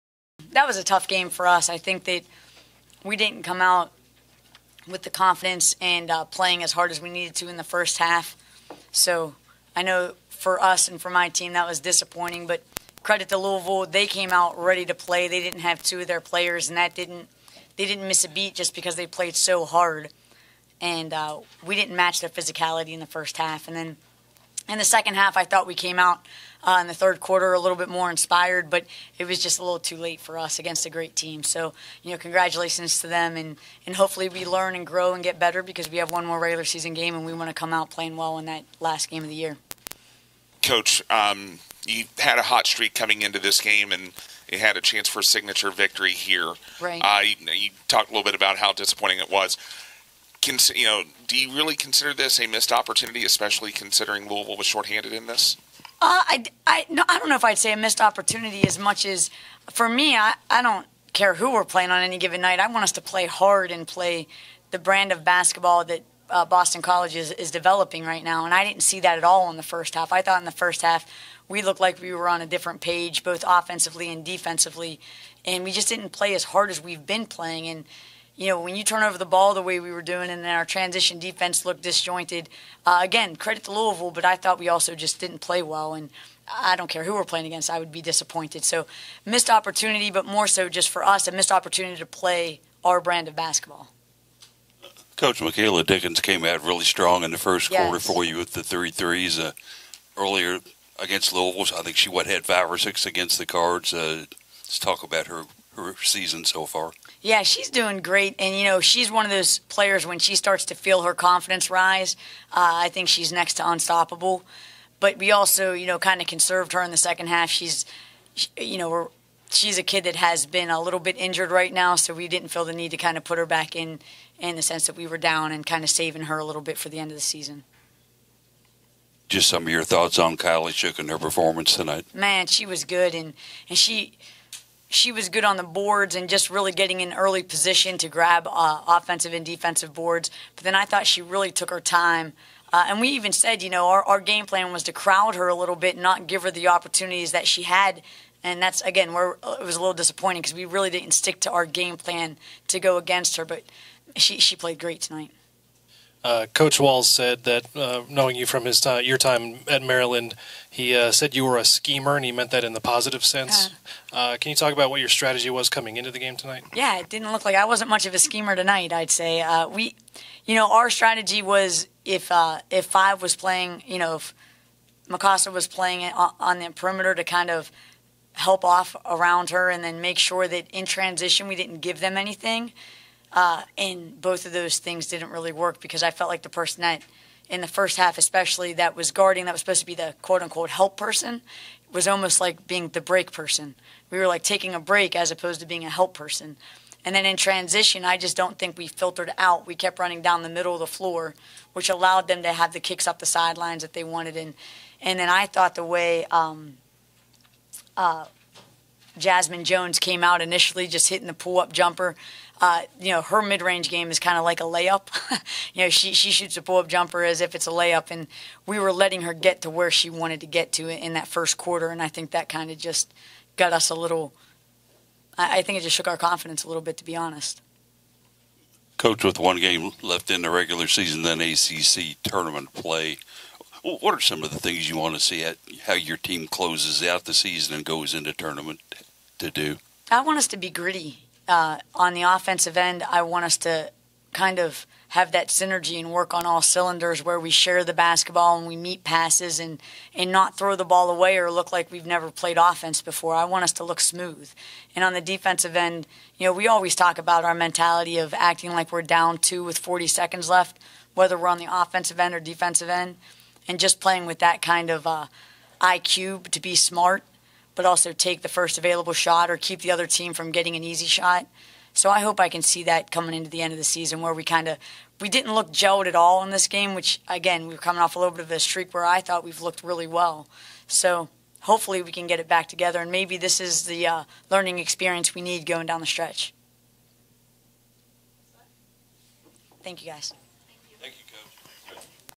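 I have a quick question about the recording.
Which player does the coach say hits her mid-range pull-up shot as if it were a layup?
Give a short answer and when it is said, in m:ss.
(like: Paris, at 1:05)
Jazmine Jones, at 3:29.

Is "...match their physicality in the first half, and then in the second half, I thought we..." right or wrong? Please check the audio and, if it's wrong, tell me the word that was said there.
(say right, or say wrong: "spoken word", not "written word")
right.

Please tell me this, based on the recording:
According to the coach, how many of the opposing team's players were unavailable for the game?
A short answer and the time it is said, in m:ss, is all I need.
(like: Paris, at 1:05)
2, at 0:15.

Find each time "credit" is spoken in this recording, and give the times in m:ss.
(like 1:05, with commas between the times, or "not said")
0:13, 1:23.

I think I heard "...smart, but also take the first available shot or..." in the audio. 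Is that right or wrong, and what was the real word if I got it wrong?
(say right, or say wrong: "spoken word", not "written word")
right.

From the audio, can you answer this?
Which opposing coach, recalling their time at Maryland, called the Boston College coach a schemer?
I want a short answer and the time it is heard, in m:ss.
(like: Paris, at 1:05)
Coach Walz, at 2:36.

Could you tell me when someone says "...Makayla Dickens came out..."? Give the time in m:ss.
1:35.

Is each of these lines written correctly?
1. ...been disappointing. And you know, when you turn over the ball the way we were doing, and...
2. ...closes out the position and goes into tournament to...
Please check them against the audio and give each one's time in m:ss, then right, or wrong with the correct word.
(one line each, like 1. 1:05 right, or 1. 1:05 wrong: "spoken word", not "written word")
1. 1:17 wrong: "playing", not "disappointing"
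2. 3:56 wrong: "season", not "position".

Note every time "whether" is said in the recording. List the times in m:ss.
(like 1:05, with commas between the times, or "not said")
4:21.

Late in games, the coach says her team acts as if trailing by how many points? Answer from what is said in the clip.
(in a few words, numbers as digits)
2.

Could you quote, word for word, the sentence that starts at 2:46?
Yeah, it didn't look like I wasn't much of a schemer tonight.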